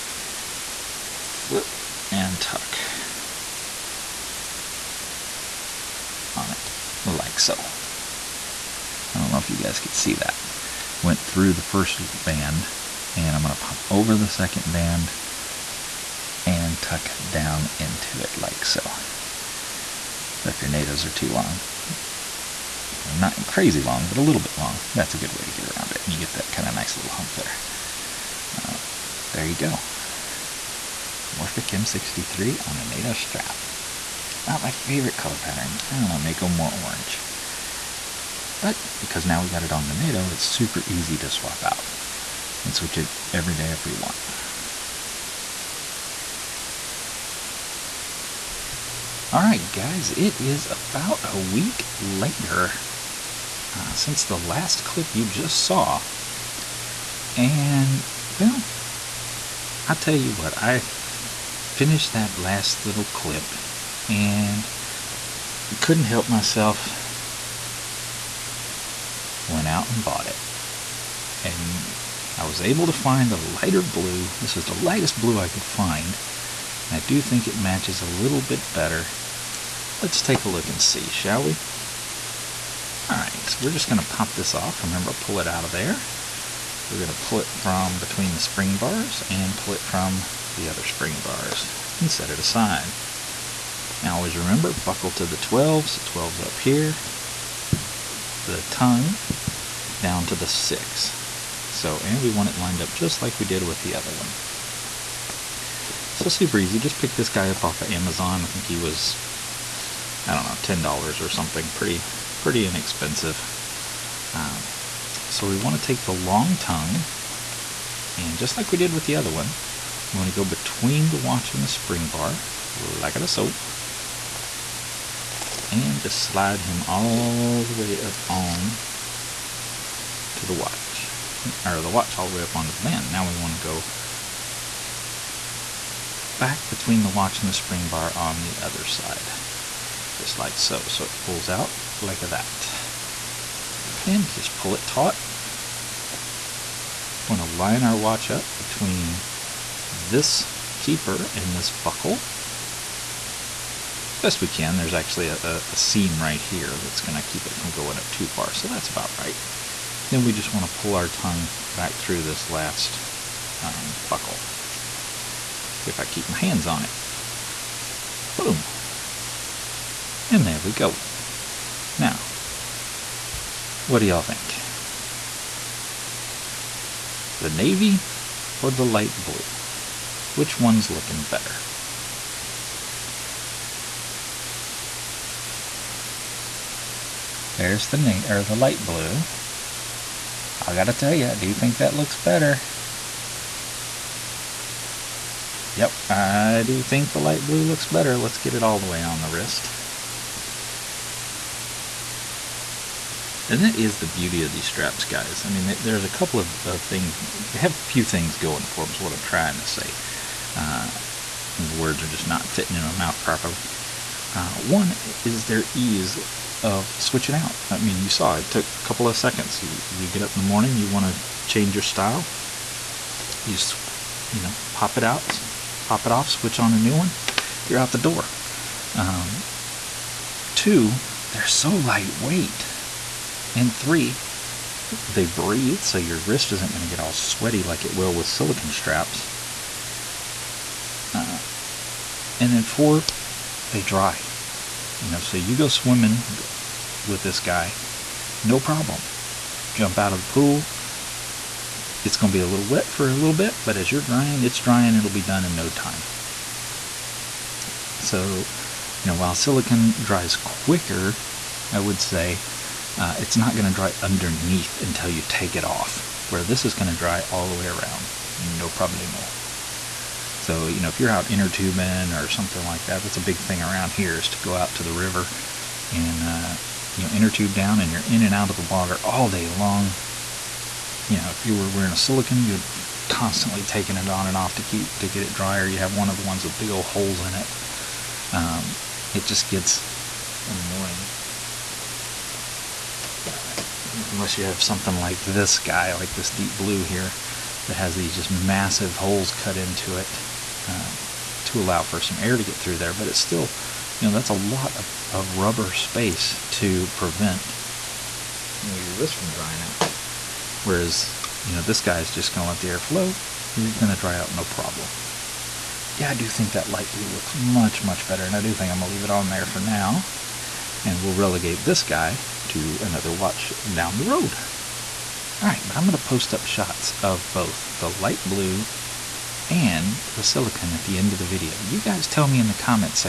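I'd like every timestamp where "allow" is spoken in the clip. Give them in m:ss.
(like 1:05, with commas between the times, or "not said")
5:01.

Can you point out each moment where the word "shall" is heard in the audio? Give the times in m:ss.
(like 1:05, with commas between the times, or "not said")
1:21.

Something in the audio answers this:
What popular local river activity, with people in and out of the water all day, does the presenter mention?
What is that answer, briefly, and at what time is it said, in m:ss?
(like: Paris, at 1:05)
inner tubing, at 4:31.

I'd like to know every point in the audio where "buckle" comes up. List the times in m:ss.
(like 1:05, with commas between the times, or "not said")
1:34, 2:31, 2:44.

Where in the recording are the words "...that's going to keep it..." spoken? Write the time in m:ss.
2:36.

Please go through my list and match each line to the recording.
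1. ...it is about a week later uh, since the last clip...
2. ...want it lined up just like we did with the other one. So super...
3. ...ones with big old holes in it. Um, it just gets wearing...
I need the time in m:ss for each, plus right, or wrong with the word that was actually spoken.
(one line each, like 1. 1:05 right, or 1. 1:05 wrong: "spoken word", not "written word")
1. 0:50 right
2. 1:42 right
3. 4:46 wrong: "annoying", not "wearing".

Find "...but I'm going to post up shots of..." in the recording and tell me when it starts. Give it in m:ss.
5:25.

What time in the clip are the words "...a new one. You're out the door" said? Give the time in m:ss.
3:46.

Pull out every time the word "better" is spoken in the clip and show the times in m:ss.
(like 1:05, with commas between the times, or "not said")
1:18, 3:01, 3:12, 3:17, 5:18.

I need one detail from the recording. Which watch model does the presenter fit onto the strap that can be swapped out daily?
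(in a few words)
Morphic M63.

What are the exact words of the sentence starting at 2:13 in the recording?
Now we want to go back between the watch and the spring bar on the other side, just like so.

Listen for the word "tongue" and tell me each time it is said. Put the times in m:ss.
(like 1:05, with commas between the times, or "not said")
1:38, 1:56, 2:41.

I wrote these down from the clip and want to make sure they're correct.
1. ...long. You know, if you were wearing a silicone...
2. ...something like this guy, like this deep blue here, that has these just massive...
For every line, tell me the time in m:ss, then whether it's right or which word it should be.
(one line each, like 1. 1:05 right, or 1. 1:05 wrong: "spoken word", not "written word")
1. 4:39 right
2. 4:54 right.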